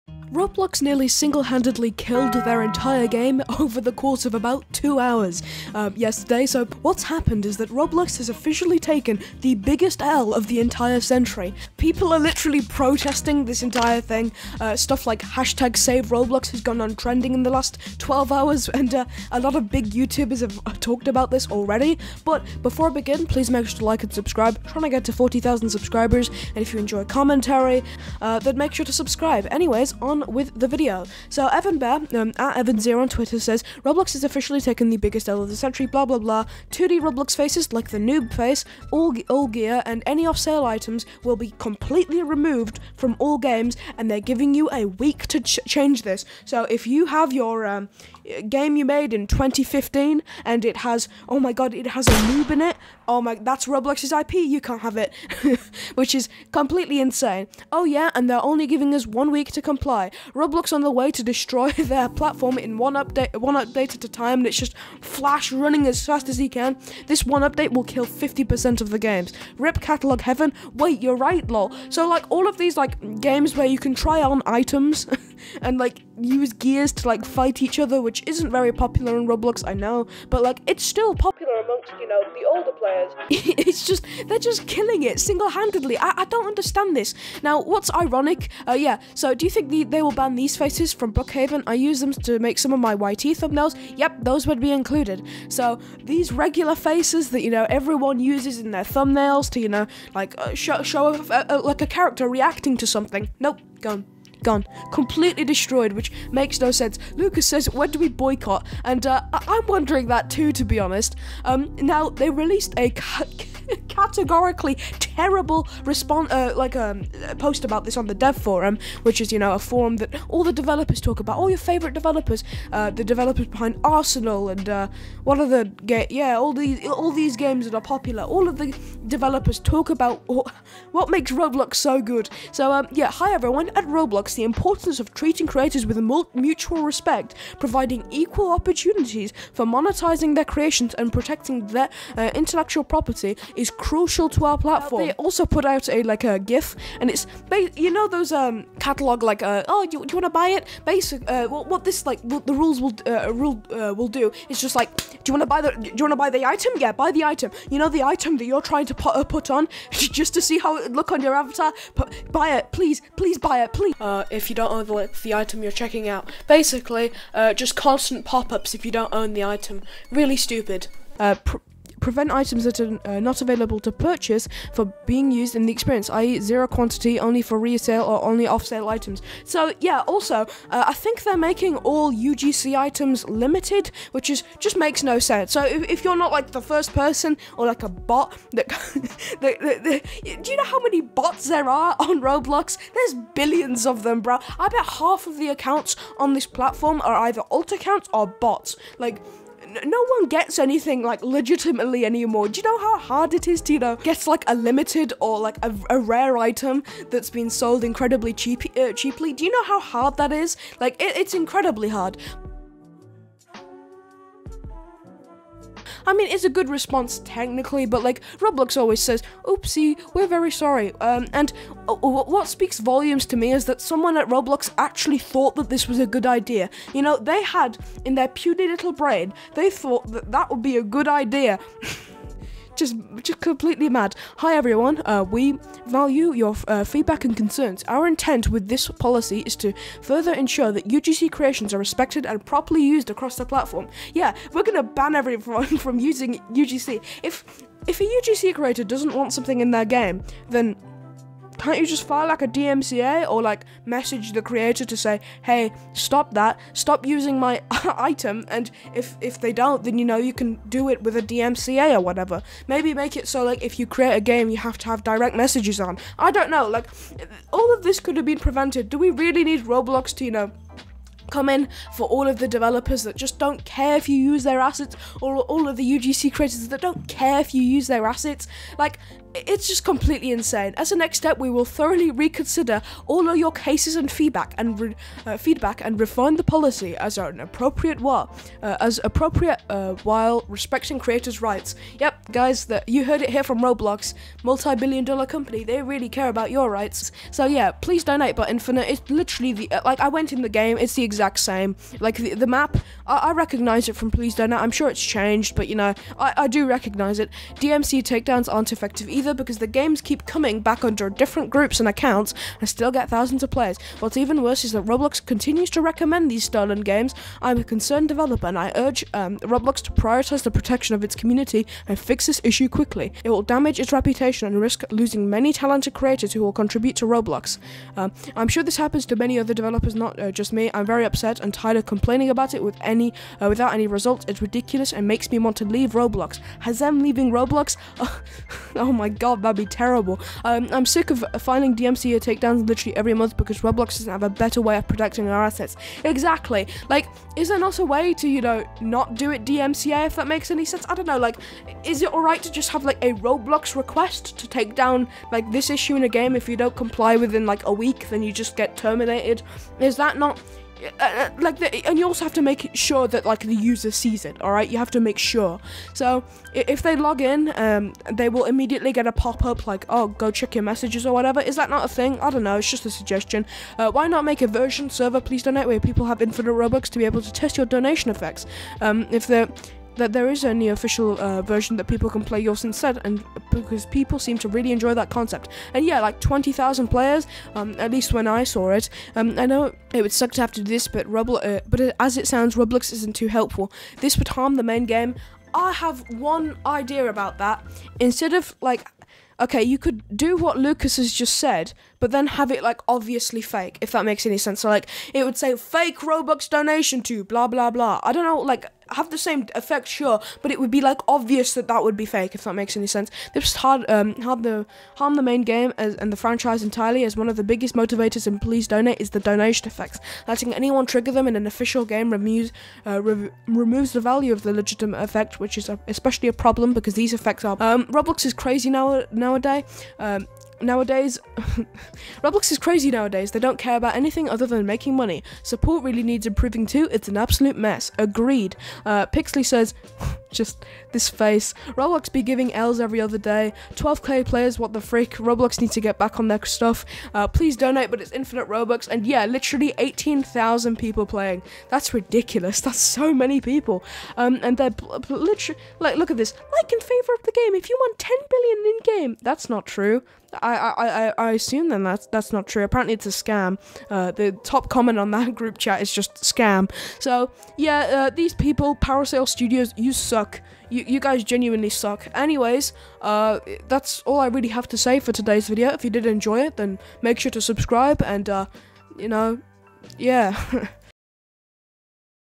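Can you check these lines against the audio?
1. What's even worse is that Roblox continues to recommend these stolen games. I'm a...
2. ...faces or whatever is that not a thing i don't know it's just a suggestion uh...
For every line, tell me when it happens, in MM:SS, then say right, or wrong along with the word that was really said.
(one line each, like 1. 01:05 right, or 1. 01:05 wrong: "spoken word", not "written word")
1. 05:13 right
2. 06:10 wrong: "messages", not "faces".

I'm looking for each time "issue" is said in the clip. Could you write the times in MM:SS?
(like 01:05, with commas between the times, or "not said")
05:22, 05:55.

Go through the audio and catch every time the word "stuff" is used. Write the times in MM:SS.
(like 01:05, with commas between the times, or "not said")
00:14, 07:26.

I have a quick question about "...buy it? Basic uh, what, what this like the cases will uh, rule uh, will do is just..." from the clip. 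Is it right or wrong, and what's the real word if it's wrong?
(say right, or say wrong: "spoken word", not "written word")
wrong: "rules", not "cases".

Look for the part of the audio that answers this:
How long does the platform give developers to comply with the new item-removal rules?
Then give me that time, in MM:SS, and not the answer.
00:59.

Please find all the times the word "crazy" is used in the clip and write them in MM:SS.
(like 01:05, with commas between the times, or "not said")
07:08, 07:12.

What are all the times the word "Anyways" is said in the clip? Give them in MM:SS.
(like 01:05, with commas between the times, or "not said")
00:29, 07:52.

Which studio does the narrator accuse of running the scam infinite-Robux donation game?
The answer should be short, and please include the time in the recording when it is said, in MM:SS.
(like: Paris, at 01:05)
Parasail Studios, at 07:48.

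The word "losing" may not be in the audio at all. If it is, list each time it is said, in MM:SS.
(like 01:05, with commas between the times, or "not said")
05:24.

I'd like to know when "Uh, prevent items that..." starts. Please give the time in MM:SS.
02:51.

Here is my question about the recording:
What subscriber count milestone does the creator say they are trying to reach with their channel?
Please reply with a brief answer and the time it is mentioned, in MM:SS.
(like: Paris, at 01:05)
40,000, at 00:25.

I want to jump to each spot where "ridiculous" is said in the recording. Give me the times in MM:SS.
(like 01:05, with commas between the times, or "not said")
05:34, 07:31.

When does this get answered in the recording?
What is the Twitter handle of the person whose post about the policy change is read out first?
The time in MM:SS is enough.
00:32.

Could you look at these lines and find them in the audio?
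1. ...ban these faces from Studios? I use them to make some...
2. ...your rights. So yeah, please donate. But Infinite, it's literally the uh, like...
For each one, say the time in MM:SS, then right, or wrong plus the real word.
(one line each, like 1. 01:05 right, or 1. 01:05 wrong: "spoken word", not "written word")
1. 01:30 wrong: "Brookhaven", not "Studios"
2. 04:56 right.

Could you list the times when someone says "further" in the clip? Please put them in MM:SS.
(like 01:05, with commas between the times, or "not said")
04:00.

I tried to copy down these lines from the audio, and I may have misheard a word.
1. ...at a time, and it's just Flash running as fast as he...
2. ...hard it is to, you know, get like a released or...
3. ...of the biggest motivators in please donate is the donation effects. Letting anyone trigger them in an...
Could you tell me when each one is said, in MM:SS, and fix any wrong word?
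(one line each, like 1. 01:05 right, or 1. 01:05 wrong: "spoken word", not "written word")
1. 01:03 right
2. 03:22 wrong: "limited", not "released"
3. 06:57 right.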